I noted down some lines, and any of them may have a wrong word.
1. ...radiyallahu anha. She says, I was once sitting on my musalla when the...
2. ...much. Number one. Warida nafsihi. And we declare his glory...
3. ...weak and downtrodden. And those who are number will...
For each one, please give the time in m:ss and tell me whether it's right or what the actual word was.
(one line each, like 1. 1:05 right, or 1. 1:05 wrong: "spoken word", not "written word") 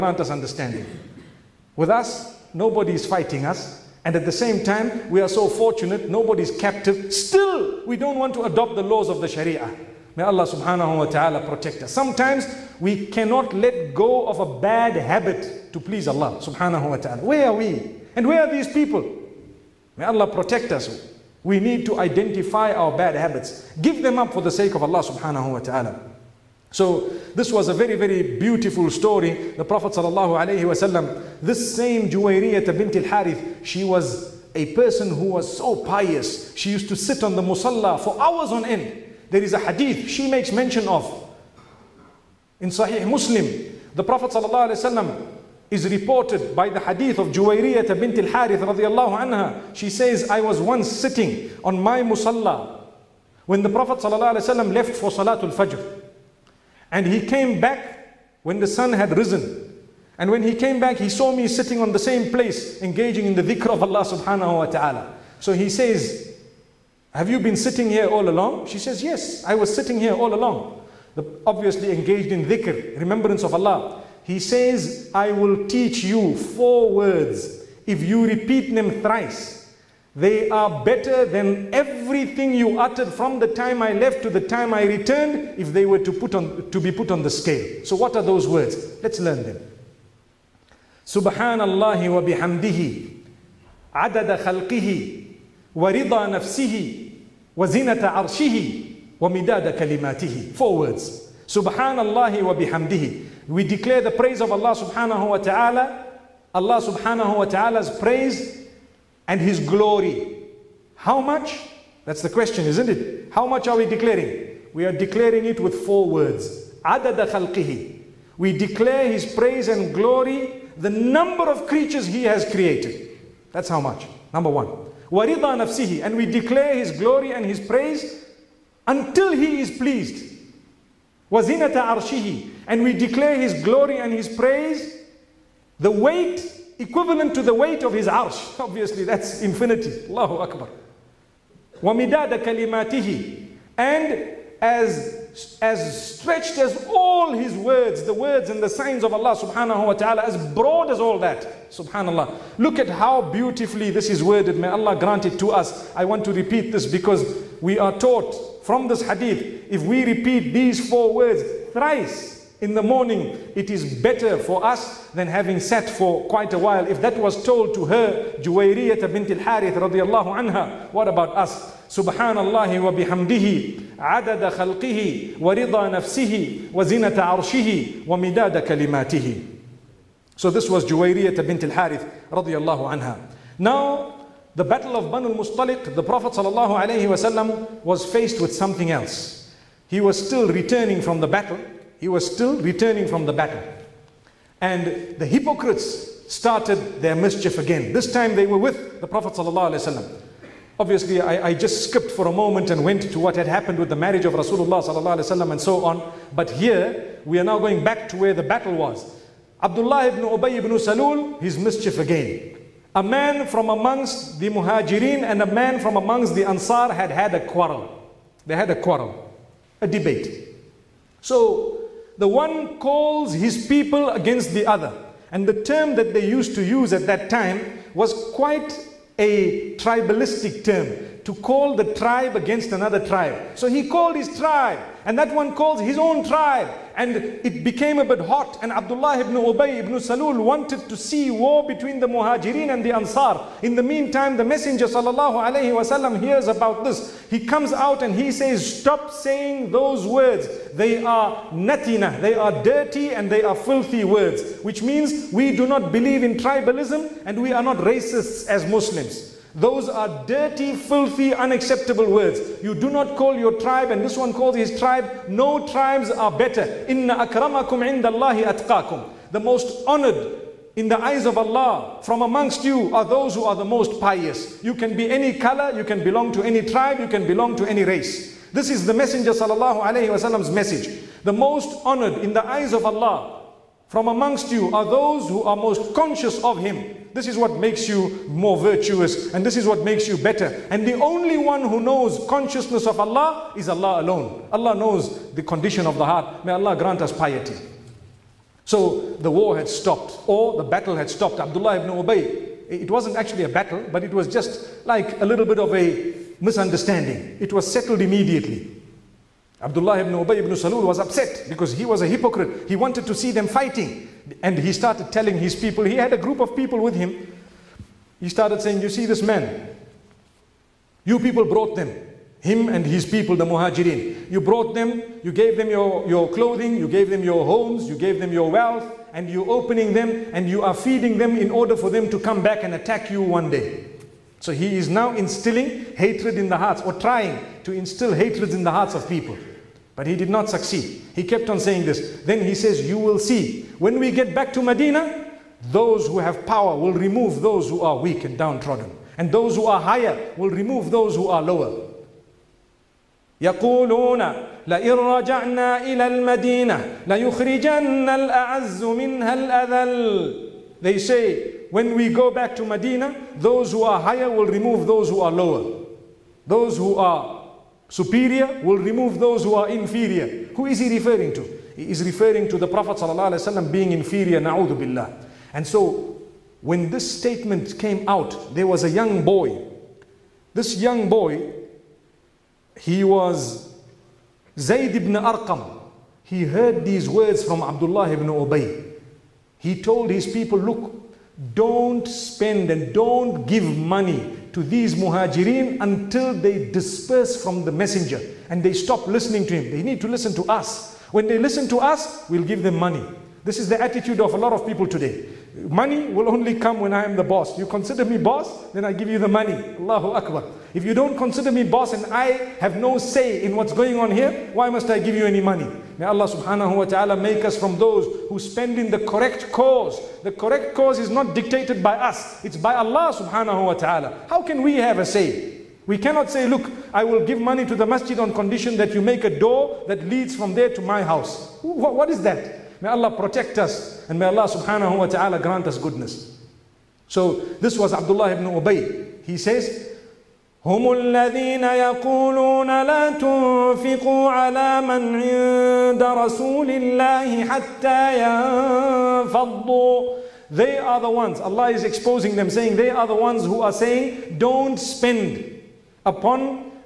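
1. 0:48 right
2. 2:03 right
3. 5:47 wrong: "higher", not "number".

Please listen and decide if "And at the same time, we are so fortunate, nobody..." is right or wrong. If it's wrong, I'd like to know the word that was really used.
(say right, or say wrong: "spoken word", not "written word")
right.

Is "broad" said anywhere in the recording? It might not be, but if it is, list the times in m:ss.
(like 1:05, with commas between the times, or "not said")
2:30.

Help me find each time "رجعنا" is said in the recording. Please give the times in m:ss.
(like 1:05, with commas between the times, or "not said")
5:54.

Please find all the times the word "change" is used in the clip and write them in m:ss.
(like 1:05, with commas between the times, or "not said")
not said.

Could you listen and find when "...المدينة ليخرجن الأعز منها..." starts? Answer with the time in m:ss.
5:56.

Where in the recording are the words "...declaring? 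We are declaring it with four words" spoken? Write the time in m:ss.
1:53.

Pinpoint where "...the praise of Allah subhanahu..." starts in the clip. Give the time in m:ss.
1:44.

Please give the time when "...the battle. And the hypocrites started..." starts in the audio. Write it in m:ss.
3:13.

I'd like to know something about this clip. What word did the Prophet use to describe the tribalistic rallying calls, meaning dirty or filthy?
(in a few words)
natina.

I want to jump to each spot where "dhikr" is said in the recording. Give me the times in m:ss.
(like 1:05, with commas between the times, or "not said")
1:03, 1:12.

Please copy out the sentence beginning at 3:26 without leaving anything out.
But here, we are now going back to where the battle was.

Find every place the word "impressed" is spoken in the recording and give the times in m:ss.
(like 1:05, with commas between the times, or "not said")
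not said.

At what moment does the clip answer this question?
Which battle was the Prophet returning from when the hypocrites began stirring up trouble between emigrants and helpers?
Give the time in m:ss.
3:05.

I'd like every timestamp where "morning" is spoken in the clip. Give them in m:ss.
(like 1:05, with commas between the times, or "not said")
2:42.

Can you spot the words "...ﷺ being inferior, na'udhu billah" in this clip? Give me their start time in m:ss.
6:12.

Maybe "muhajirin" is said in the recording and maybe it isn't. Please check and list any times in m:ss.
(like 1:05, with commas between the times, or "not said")
3:34, 4:02, 5:23, 6:34.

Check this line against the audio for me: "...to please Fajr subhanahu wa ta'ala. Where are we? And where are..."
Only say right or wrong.
wrong.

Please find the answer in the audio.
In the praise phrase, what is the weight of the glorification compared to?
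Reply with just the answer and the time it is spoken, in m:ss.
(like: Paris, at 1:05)
his arsh, at 2:17.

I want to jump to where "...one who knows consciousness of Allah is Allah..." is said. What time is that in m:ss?
4:51.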